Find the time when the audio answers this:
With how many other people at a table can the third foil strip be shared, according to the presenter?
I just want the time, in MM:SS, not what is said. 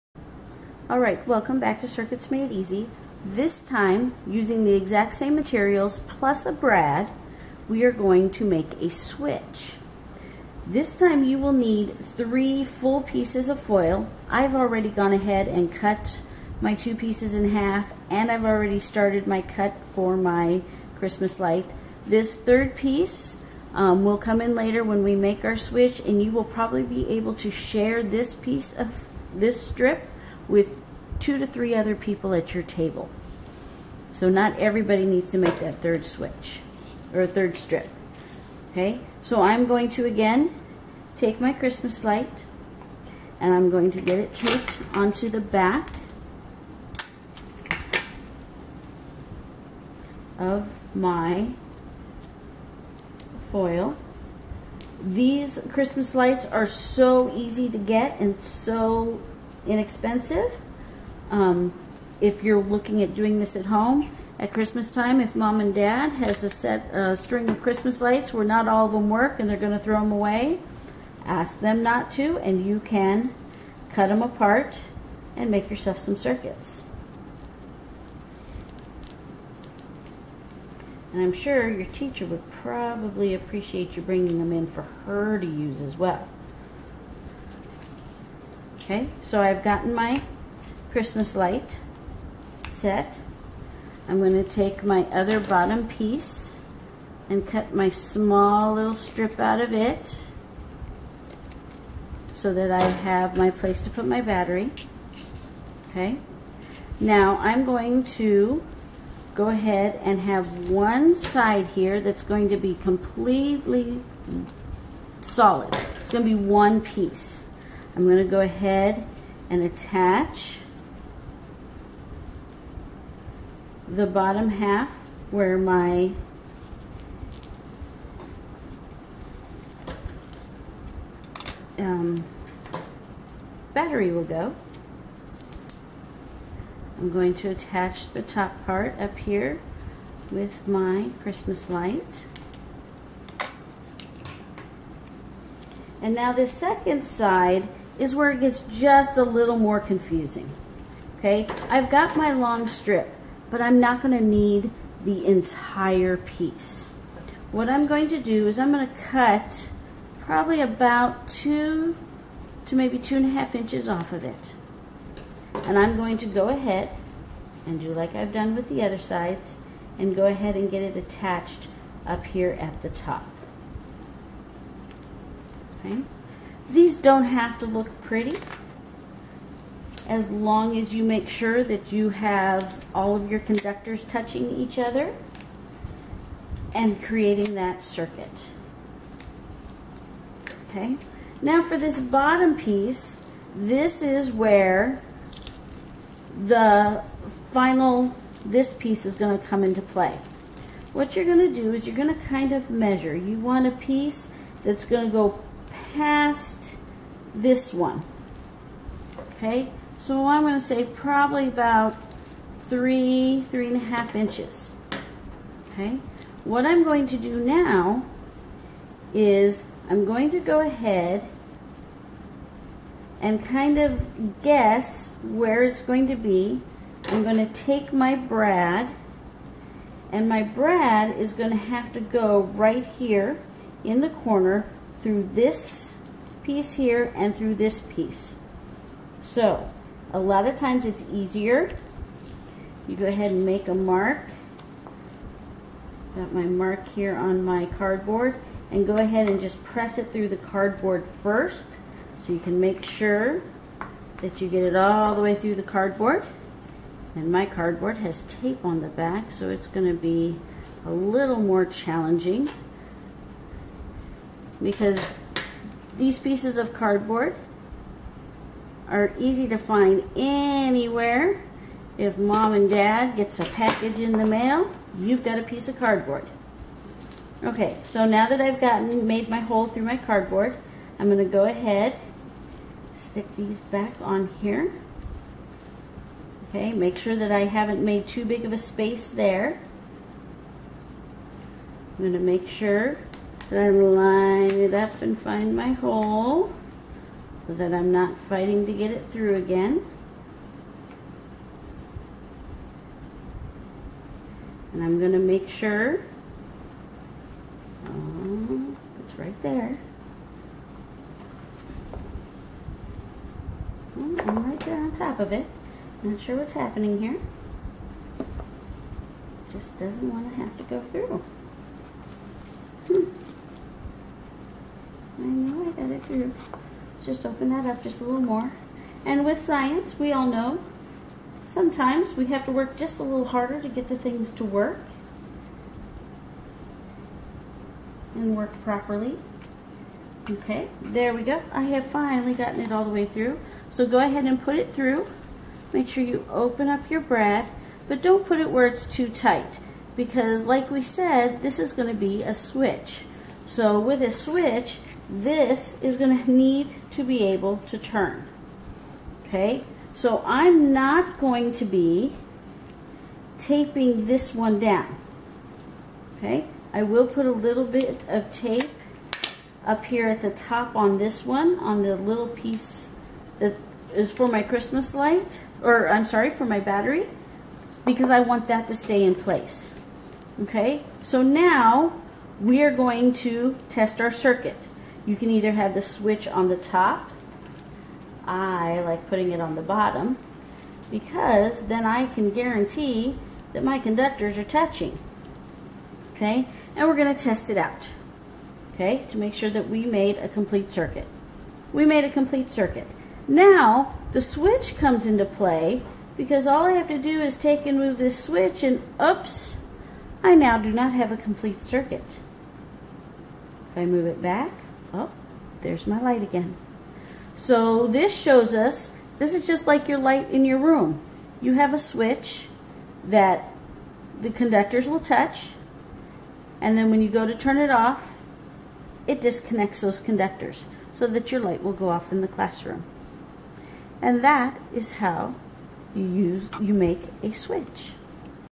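00:31.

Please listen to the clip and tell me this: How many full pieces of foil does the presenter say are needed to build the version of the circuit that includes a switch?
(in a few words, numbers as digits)
3.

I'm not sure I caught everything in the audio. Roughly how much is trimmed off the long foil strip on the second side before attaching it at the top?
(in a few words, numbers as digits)
2 to 2.5 inches.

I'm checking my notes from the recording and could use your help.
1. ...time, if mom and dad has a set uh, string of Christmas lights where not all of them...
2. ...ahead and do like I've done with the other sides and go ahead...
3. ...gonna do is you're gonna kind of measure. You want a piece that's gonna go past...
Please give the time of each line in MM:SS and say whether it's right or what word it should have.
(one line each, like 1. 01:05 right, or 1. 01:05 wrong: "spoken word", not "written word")
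1. 01:04 right
2. 02:46 right
3. 03:21 right.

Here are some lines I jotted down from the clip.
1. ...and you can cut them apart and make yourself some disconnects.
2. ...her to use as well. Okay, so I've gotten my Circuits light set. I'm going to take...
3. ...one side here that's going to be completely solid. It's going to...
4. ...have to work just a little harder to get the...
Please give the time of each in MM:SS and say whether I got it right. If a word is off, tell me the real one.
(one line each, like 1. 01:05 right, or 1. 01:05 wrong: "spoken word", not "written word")
1. 01:12 wrong: "circuits", not "disconnects"
2. 01:25 wrong: "Christmas", not "Circuits"
3. 01:50 right
4. 05:32 right.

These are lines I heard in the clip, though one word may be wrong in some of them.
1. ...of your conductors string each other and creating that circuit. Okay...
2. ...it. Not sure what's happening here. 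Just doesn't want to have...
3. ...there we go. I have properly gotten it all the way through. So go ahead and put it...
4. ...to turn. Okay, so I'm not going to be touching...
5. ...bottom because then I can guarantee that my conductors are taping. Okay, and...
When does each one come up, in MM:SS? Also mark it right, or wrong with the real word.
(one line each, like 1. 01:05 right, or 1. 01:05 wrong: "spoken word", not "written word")
1. 03:03 wrong: "touching", not "string"
2. 05:15 right
3. 05:40 wrong: "finally", not "properly"
4. 05:57 wrong: "taping", not "touching"
5. 06:29 wrong: "touching", not "taping".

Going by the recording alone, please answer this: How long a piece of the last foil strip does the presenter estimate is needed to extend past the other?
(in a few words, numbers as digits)
3 to 3.5 inches.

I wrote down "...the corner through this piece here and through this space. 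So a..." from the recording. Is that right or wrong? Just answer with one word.
wrong.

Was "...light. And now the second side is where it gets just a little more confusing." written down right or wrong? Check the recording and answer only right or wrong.
right.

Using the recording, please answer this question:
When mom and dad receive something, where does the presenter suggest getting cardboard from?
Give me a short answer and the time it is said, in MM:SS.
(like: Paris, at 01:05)
A package in the mail, at 04:33.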